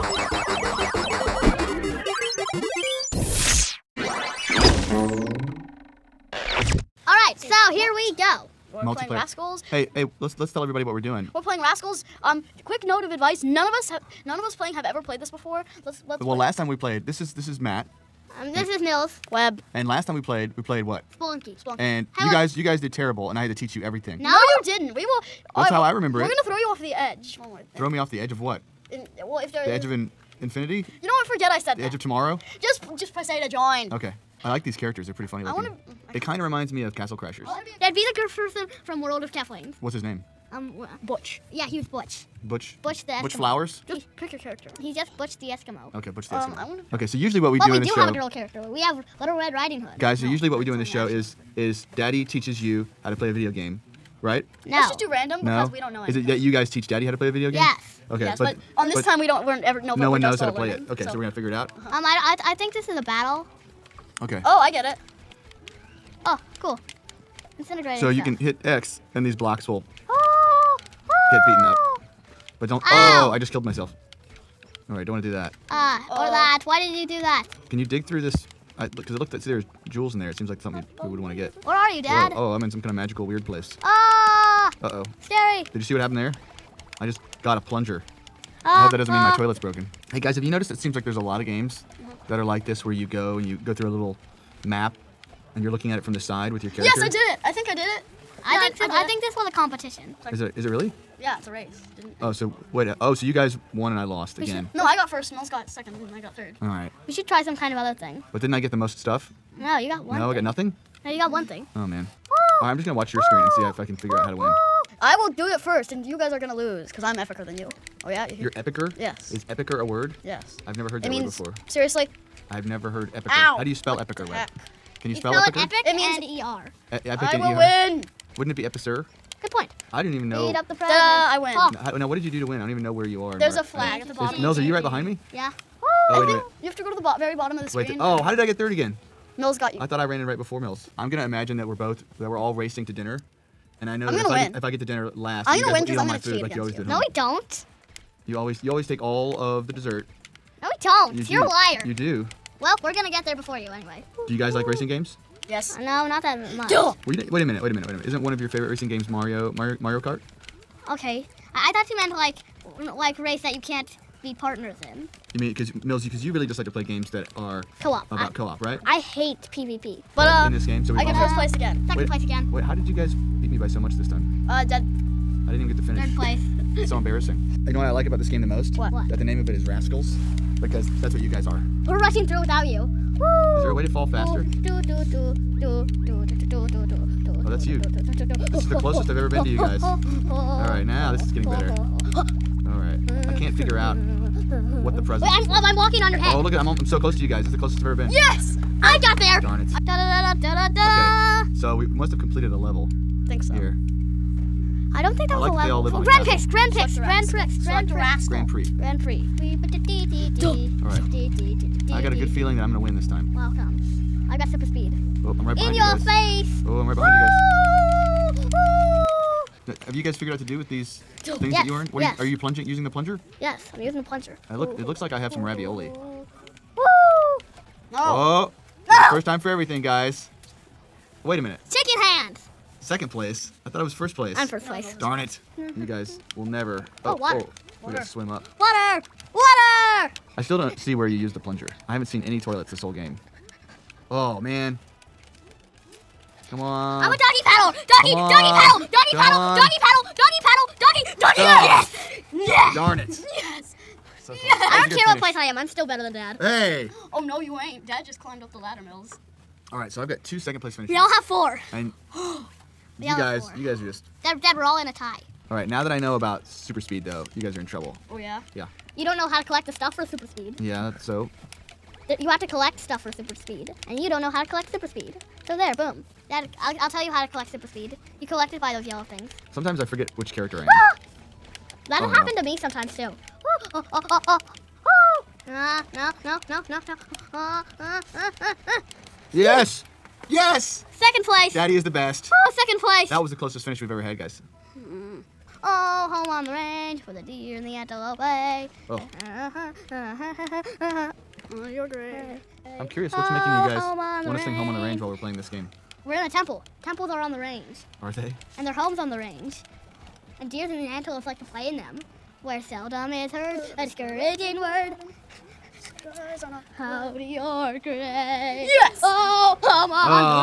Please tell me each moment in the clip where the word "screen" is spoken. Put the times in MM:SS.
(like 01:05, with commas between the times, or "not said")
01:53, 02:17.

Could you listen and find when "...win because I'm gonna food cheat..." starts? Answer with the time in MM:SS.
02:25.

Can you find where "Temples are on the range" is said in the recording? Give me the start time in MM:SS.
05:06.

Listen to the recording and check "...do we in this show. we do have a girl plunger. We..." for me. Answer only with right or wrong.
wrong.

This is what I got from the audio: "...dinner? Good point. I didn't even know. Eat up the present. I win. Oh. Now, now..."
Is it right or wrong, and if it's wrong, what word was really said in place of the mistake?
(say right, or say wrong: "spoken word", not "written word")
wrong: "epicer", not "dinner".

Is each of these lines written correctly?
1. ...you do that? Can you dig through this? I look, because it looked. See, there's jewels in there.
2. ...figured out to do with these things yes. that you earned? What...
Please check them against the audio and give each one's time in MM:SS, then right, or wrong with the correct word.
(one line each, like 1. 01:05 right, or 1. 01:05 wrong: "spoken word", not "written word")
1. 01:16 right
2. 03:40 right.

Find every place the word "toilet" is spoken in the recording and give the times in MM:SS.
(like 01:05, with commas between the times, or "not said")
01:29, 04:02.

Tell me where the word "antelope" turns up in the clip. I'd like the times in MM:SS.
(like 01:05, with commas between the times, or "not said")
04:57, 05:10.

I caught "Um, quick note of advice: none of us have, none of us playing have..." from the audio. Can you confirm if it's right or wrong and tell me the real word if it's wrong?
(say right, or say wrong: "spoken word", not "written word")
right.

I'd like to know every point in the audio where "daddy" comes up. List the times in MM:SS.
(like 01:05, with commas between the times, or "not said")
00:51, 00:56, 04:51.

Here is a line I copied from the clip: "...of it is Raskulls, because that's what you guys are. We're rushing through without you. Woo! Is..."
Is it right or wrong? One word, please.
right.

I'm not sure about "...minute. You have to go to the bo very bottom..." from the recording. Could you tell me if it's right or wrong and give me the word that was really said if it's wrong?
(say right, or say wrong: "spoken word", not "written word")
right.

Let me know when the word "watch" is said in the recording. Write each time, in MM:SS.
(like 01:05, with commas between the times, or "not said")
01:52.